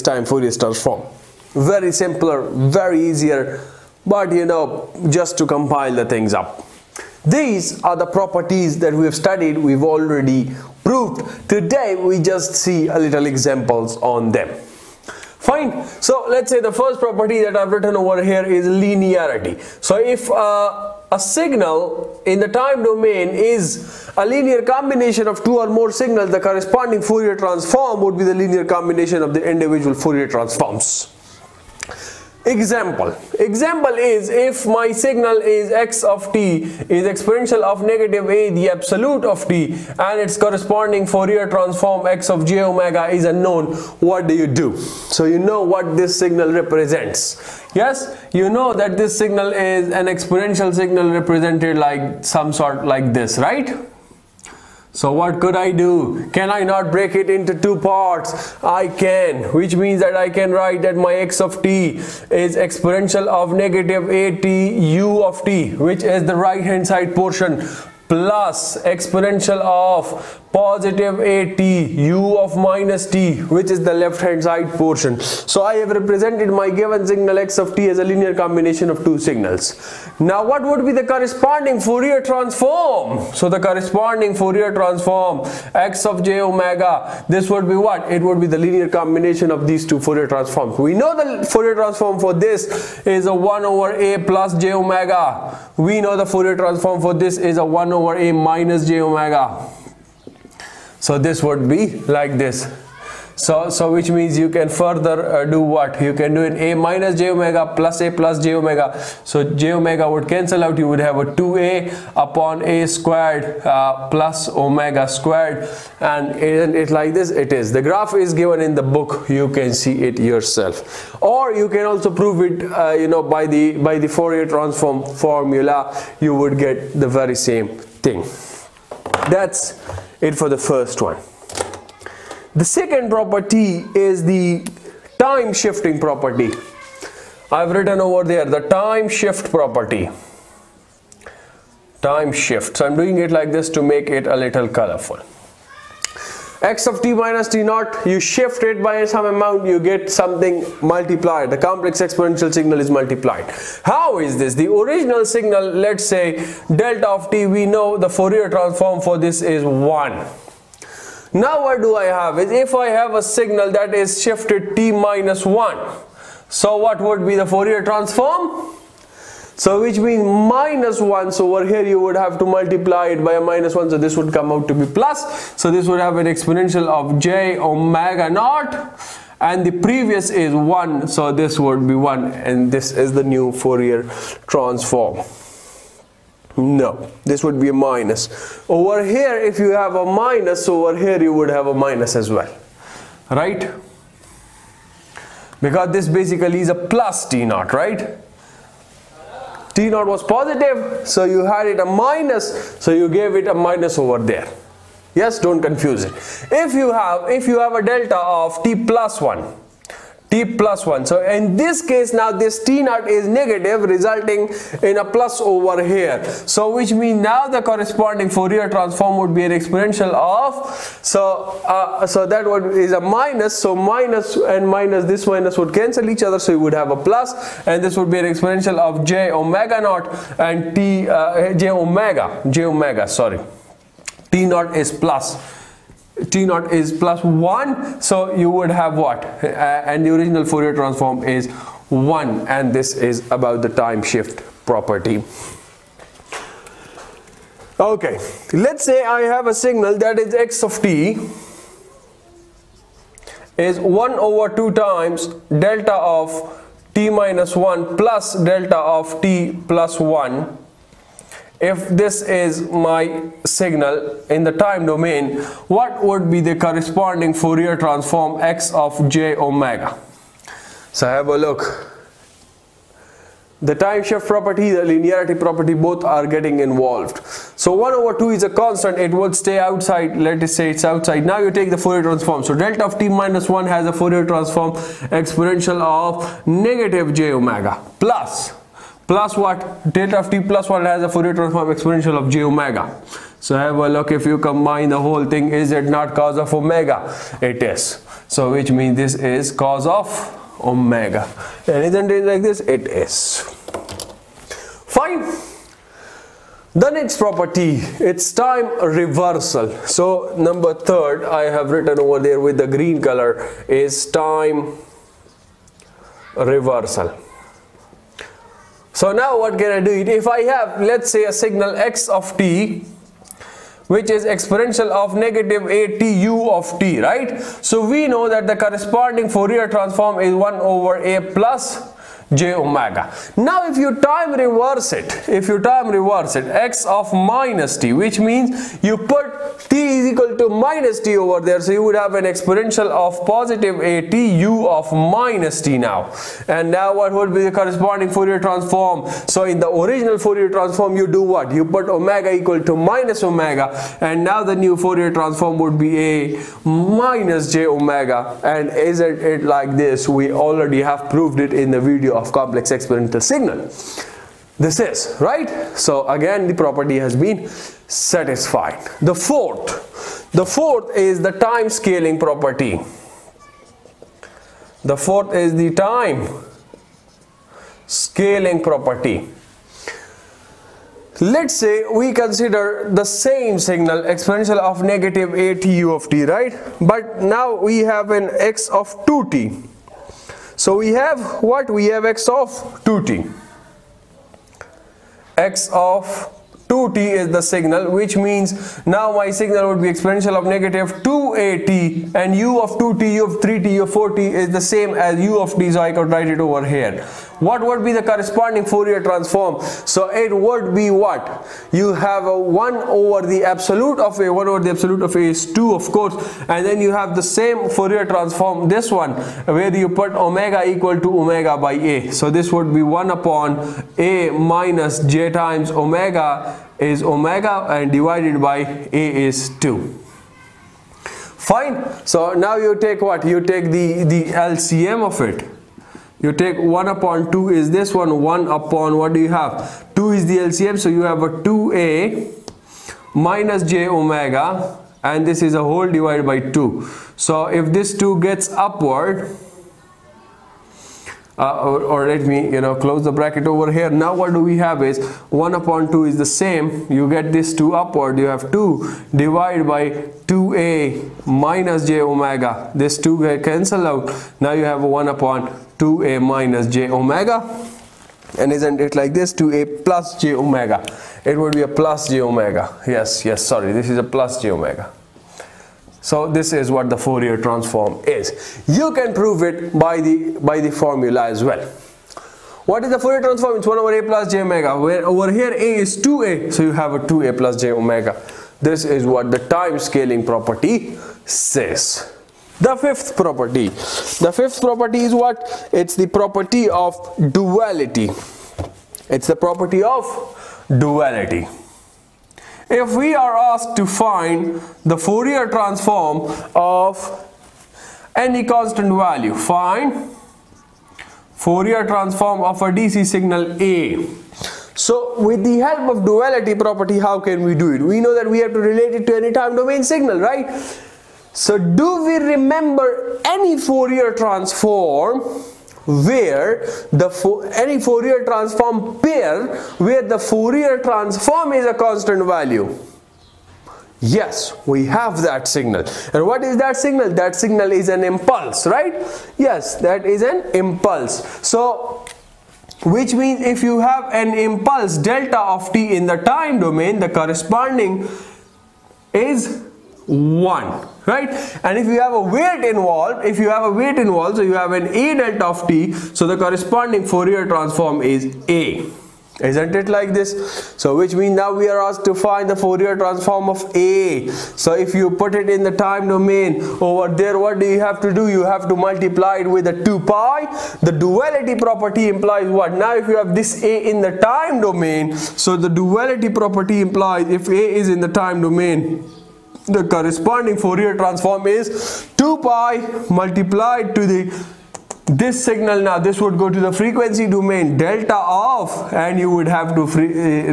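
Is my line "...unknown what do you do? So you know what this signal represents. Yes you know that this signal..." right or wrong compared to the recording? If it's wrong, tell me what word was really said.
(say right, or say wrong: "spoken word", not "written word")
right.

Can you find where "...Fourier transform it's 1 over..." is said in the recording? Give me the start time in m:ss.
8:03.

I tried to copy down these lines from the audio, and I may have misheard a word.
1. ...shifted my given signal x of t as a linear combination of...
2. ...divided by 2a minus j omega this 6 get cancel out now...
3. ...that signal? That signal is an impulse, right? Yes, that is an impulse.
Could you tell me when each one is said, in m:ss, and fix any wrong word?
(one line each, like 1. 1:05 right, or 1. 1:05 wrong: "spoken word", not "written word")
1. 1:15 wrong: "represented", not "shifted"
2. 7:39 wrong: "2", not "6"
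3. 8:56 right.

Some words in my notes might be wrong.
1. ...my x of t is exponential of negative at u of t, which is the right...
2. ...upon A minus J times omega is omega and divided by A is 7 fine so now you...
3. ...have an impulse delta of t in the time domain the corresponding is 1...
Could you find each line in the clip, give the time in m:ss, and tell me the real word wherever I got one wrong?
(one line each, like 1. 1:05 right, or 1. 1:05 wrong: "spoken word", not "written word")
1. 1:00 right
2. 7:03 wrong: "2", not "7"
3. 9:03 right.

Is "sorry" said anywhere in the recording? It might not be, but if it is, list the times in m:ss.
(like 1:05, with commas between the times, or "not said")
3:53, 7:53.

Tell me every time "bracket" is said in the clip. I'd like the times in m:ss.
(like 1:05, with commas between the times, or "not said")
7:33.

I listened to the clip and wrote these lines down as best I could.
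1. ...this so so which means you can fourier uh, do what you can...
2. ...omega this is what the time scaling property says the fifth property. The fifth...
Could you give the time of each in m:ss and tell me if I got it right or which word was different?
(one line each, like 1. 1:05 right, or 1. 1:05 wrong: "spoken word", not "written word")
1. 1:42 wrong: "further", not "fourier"
2. 8:07 right.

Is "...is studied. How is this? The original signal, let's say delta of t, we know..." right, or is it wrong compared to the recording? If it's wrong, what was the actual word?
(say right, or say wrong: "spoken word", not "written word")
wrong: "multiplied", not "studied".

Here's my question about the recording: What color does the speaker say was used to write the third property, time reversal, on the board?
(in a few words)
green.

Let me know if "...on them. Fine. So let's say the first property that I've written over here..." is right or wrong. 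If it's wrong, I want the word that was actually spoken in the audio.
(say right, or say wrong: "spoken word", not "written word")
right.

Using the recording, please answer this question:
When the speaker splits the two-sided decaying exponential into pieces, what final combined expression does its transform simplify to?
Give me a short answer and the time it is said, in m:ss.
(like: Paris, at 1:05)
2a over a squared plus omega squared, at 1:51.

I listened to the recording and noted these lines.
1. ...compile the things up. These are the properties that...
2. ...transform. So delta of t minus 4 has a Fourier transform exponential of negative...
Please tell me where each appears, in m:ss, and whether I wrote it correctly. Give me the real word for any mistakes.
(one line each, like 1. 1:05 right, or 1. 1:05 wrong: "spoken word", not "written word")
1. 0:05 right
2. 4:42 wrong: "1", not "4".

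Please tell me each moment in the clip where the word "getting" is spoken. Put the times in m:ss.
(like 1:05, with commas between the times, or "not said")
4:36.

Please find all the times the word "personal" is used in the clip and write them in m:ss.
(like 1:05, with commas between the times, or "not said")
not said.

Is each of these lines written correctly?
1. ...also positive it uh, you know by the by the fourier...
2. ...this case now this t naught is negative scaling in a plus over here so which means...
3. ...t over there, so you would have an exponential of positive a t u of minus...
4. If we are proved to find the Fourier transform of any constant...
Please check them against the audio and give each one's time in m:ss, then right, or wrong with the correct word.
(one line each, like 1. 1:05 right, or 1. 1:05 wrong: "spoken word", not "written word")
1. 2:01 wrong: "prove", not "positive"
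2. 3:31 wrong: "resulting", not "scaling"
3. 5:40 right
4. 8:22 wrong: "asked", not "proved".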